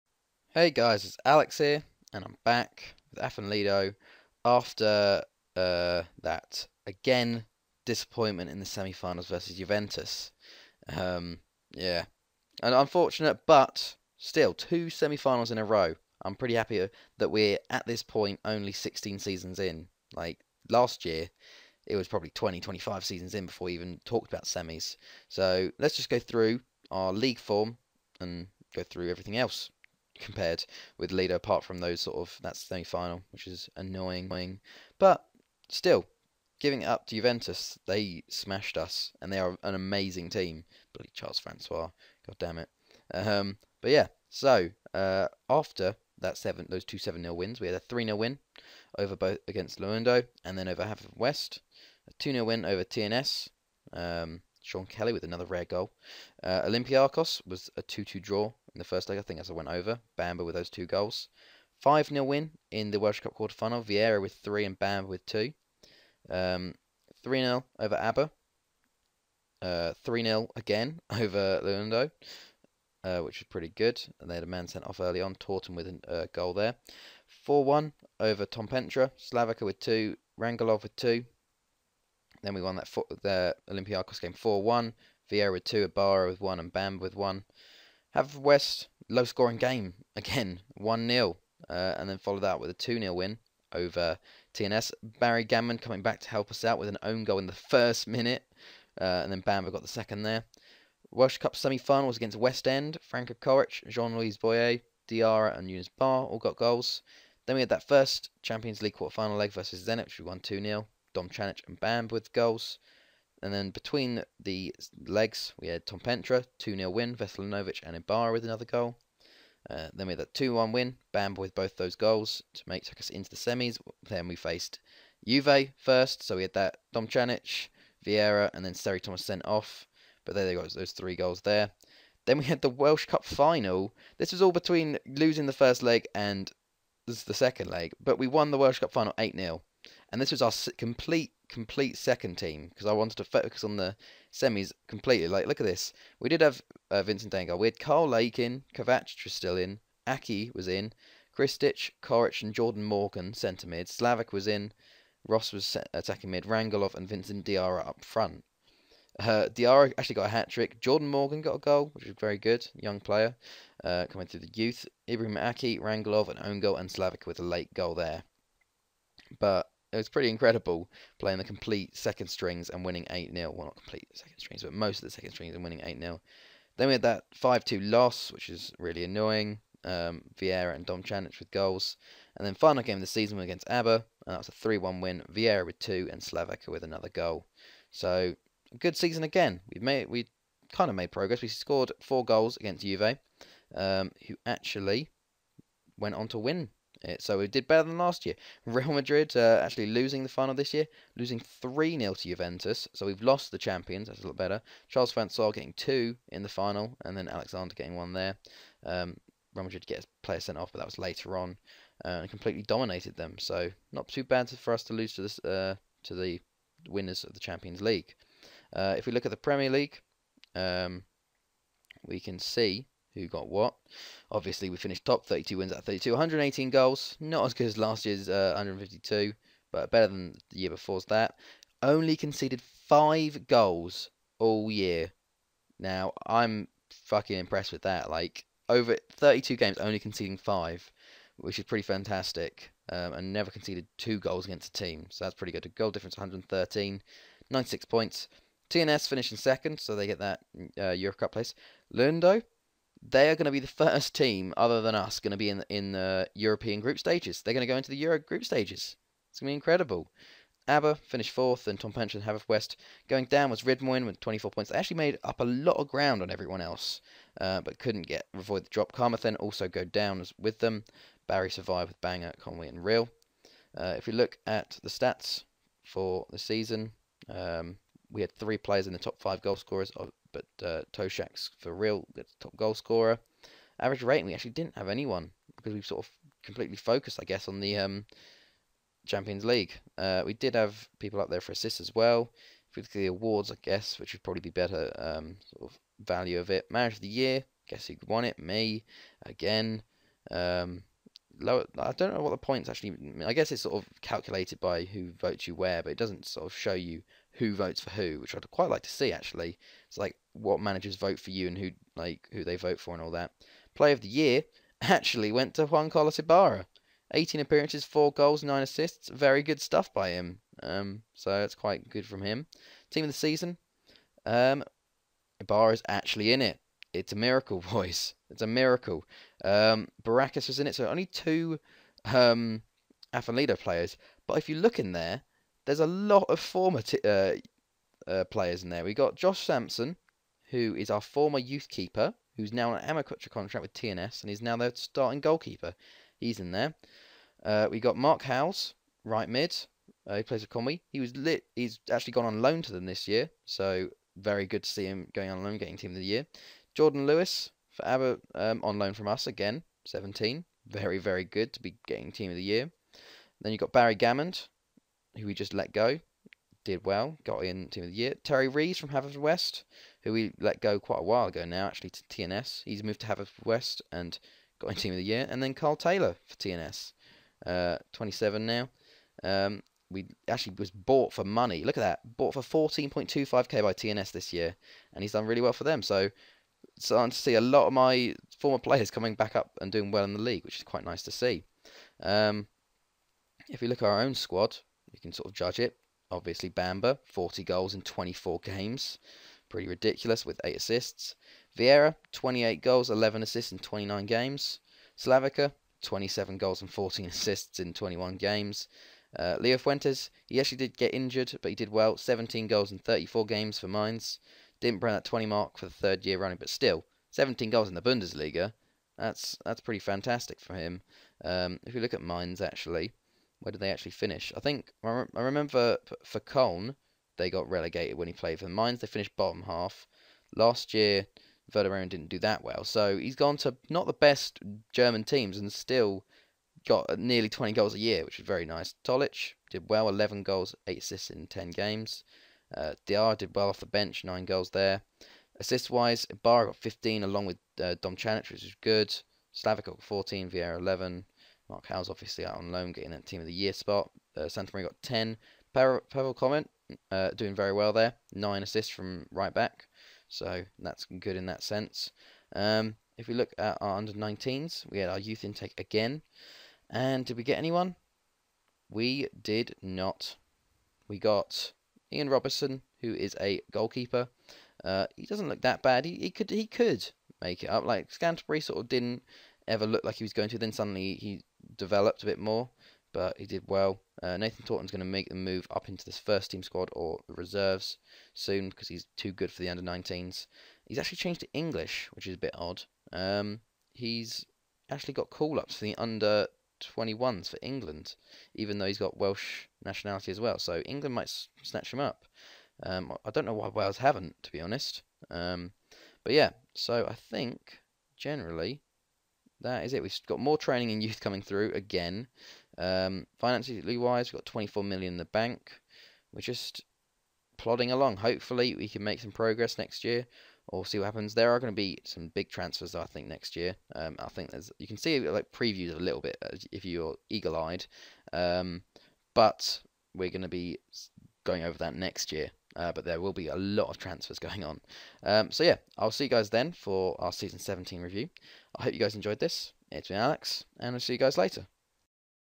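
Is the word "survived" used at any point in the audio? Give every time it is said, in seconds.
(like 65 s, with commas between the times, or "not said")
271 s.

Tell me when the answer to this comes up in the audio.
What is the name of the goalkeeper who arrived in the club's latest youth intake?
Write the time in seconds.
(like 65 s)
471 s.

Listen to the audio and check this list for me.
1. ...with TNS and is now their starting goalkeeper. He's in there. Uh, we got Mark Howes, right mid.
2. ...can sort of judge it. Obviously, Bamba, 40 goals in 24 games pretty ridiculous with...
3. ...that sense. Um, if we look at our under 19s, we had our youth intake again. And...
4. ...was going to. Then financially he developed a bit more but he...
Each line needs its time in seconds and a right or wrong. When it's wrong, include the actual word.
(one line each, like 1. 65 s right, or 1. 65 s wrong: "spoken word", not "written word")
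1. 343 s right
2. 394 s right
3. 461 s right
4. 480 s wrong: "suddenly", not "financially".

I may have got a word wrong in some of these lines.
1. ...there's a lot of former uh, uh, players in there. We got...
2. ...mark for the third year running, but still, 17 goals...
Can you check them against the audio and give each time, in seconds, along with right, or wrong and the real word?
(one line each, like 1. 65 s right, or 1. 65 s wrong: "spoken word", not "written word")
1. 335 s right
2. 415 s right.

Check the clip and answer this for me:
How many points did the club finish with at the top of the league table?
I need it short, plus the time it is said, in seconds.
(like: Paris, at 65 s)
96, at 247 s.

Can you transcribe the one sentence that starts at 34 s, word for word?
But still, giving it up to Juventus, they smashed us, and they are an amazing team.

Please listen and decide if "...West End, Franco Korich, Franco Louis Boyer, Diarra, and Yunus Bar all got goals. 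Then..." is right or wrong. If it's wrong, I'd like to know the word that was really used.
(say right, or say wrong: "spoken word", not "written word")
wrong: "Jean", not "Franco".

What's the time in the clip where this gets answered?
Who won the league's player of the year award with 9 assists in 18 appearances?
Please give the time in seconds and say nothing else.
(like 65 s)
315 s.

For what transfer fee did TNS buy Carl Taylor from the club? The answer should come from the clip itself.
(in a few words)
14.25k.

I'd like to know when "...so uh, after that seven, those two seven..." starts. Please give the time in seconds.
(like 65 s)
44 s.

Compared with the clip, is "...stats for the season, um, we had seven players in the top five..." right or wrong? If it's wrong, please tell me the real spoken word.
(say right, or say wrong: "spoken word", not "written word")
wrong: "three", not "seven".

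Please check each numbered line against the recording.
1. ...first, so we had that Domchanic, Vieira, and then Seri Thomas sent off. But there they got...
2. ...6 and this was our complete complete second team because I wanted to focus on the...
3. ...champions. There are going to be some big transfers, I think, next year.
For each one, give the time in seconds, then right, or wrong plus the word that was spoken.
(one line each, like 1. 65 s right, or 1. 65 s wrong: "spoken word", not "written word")
1. 125 s right
2. 139 s wrong: "0", not "6"
3. 520 s wrong: "happens", not "champions".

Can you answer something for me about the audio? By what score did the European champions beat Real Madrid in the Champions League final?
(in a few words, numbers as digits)
3-0.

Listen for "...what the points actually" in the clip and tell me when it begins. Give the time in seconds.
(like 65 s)
302 s.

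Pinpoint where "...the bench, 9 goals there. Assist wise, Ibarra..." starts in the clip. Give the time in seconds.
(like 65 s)
443 s.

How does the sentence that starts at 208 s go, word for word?
Um, Real Madrid gets player sent off, but that was later on, uh, and completely dominated them.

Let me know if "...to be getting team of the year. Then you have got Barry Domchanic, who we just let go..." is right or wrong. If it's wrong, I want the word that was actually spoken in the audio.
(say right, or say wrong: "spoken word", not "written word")
wrong: "Gammond", not "Domchanic".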